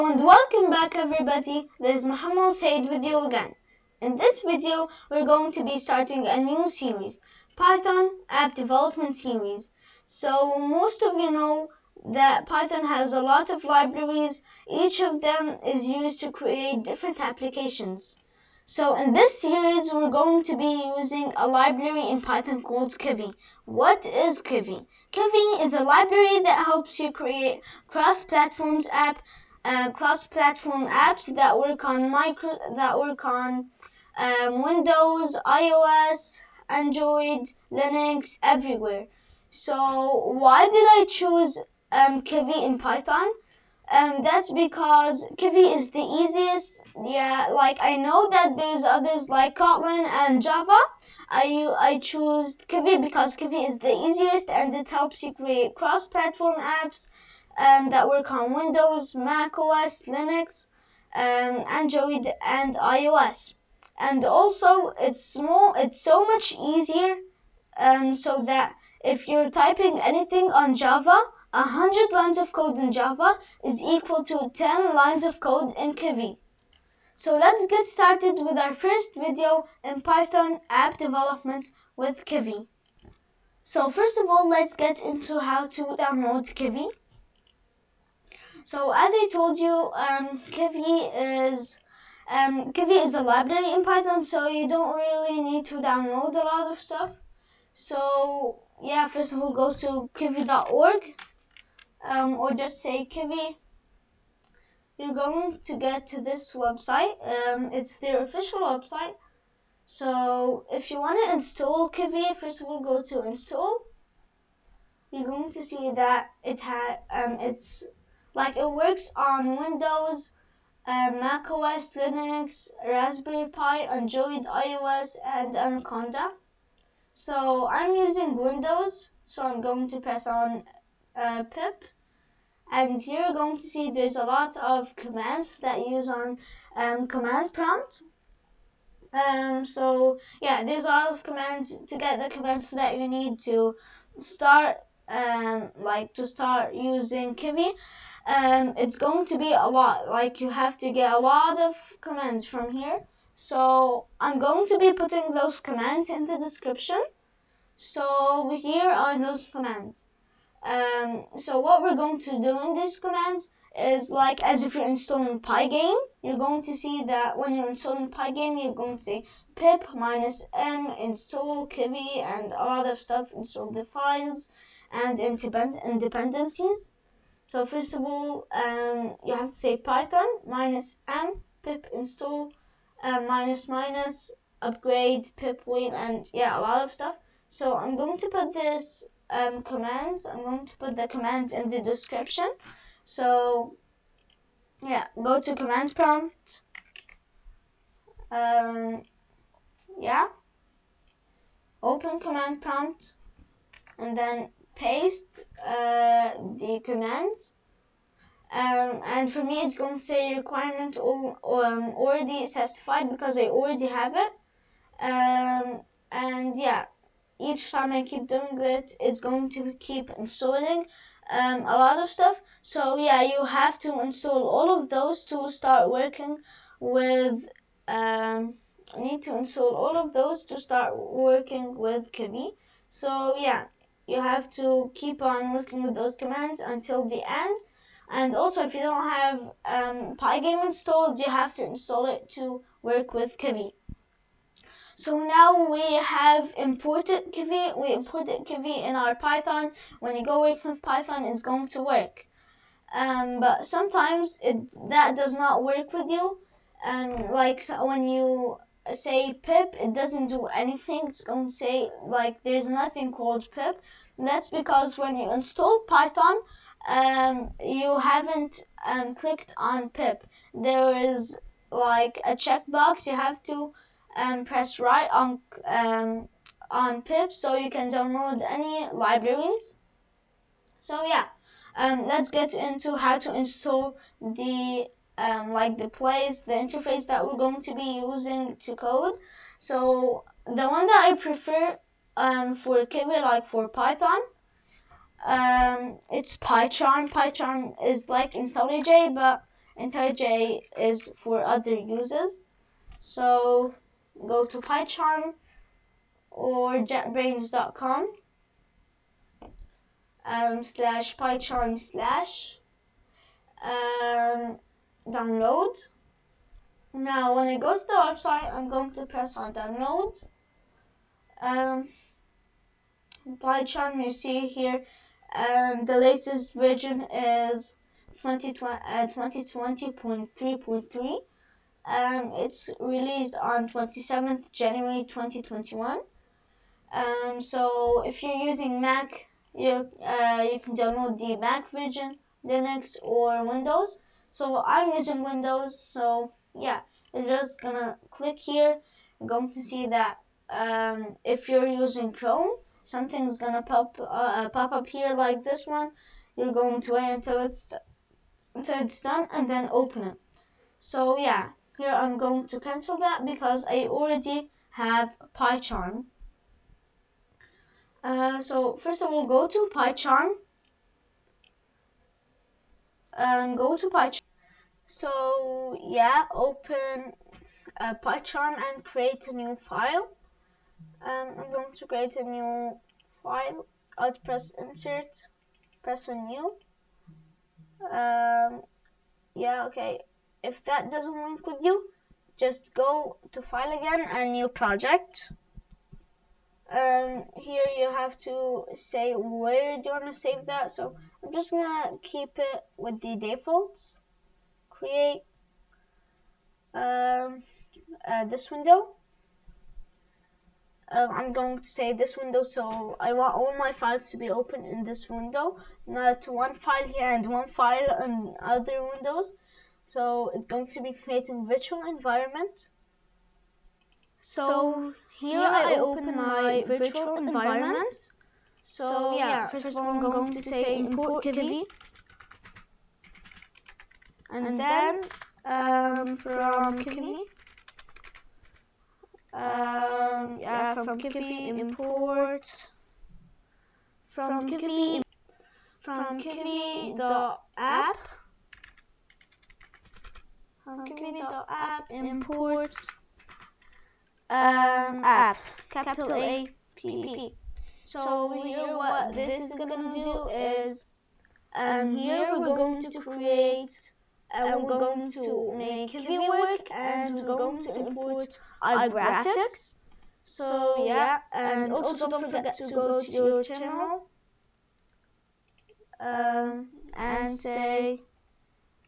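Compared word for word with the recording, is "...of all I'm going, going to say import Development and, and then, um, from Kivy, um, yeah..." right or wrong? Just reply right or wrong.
wrong.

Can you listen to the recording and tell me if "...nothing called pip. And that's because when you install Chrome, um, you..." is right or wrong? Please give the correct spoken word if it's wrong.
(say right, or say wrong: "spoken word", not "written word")
wrong: "Python", not "Chrome".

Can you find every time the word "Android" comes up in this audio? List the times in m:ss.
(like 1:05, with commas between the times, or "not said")
0:36, 1:01, 2:03.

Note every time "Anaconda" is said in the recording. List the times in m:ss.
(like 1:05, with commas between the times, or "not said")
2:05.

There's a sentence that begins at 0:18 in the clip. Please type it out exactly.
So in this series, we're going to be using a library in Python called Kivy.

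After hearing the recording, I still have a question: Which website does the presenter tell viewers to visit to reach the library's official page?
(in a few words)
kivy.org.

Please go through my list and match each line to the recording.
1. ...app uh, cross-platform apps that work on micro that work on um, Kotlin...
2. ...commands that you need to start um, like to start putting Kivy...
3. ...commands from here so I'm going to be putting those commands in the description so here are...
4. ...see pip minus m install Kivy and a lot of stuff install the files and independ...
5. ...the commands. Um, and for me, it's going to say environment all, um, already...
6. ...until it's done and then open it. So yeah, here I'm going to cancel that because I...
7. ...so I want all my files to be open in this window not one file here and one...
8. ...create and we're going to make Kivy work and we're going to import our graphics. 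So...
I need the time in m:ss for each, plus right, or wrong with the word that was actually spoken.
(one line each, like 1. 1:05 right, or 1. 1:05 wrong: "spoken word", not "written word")
1. 0:28 wrong: "Windows", not "Kotlin"
2. 2:22 wrong: "using", not "putting"
3. 2:32 right
4. 2:49 right
5. 3:26 wrong: "requirement", not "environment"
6. 5:58 right
7. 6:52 right
8. 7:42 right.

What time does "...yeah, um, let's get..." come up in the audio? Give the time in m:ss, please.
4:41.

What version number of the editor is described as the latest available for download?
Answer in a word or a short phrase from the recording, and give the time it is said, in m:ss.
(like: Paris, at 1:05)
2020.3.3, at 5:28.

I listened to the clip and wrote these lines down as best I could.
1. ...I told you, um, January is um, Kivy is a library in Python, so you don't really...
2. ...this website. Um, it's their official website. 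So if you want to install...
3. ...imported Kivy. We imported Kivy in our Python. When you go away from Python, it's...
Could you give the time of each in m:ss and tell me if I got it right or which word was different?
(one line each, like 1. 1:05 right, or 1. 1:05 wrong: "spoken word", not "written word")
1. 1:29 wrong: "Kivy", not "January"
2. 1:46 right
3. 4:06 right.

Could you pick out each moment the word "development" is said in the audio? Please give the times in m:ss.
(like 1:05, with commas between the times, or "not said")
0:08, 1:20.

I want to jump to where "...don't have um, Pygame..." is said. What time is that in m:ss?
3:58.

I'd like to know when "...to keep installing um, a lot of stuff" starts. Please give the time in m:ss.
3:39.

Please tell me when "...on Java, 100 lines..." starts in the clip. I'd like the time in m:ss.
1:10.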